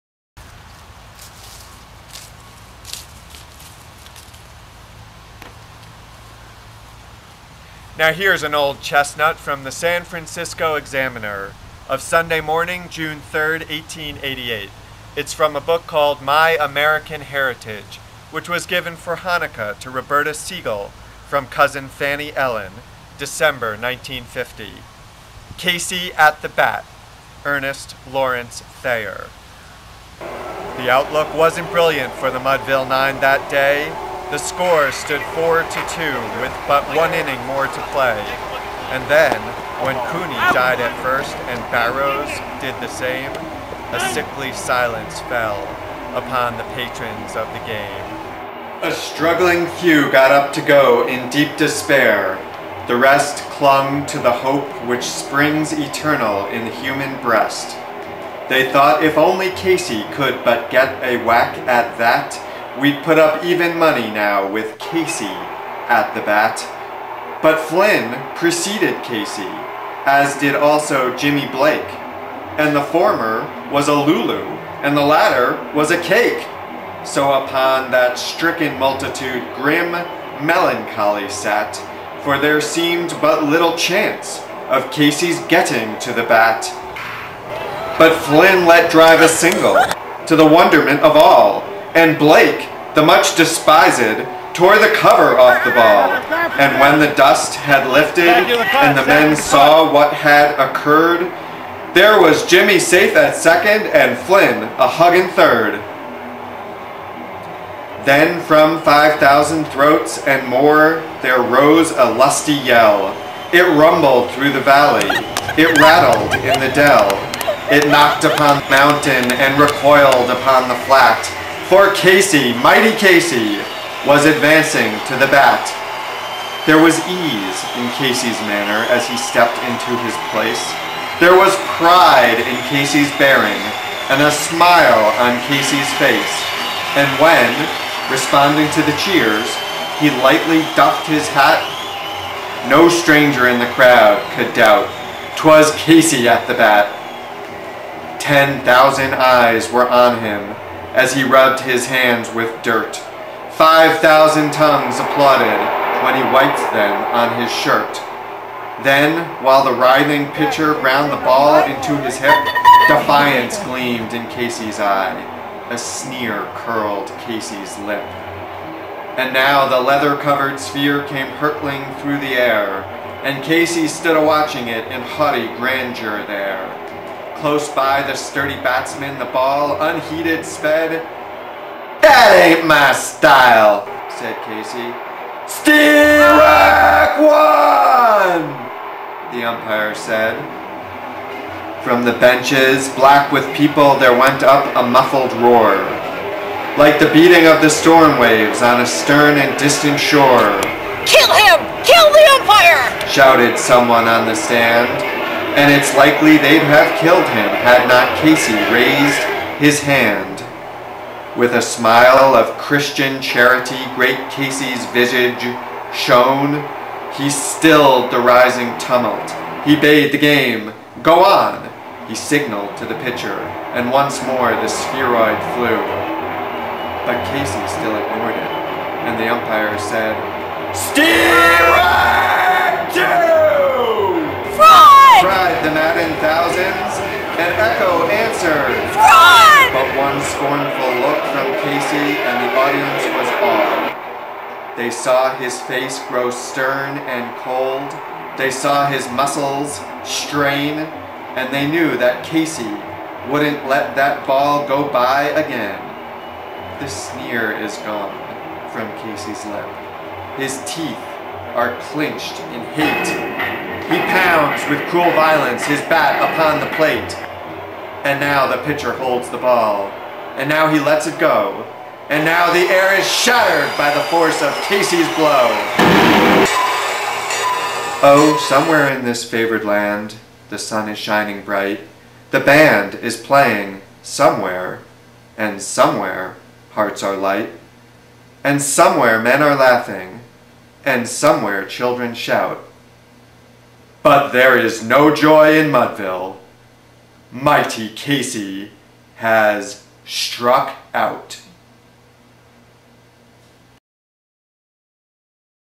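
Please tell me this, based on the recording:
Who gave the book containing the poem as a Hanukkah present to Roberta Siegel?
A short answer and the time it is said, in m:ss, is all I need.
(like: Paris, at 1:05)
cousin Fanny Ellen, at 0:21.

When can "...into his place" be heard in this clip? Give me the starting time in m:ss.
2:09.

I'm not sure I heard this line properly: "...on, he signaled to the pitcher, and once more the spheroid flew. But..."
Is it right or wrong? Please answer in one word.
right.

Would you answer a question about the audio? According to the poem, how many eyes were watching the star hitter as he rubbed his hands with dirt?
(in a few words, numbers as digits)
10,000.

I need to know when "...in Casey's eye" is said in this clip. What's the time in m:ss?
2:44.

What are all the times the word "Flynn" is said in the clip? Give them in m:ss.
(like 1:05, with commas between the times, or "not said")
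1:07, 1:28, 1:44.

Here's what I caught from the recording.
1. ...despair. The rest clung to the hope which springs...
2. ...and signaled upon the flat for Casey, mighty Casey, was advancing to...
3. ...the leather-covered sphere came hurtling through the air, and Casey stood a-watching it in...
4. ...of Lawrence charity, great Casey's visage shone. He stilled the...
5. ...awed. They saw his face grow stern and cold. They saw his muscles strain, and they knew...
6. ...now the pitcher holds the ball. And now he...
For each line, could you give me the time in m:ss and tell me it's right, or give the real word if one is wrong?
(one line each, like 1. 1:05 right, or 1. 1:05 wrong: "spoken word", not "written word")
1. 0:51 right
2. 1:59 wrong: "recoiled", not "signaled"
3. 2:49 right
4. 3:32 wrong: "Christian", not "Lawrence"
5. 4:03 right
6. 4:28 right.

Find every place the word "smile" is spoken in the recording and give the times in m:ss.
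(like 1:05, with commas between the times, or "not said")
2:14, 3:31.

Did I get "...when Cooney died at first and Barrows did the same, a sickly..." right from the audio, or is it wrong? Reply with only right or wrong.
right.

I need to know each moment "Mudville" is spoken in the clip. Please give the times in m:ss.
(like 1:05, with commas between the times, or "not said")
0:32, 4:55.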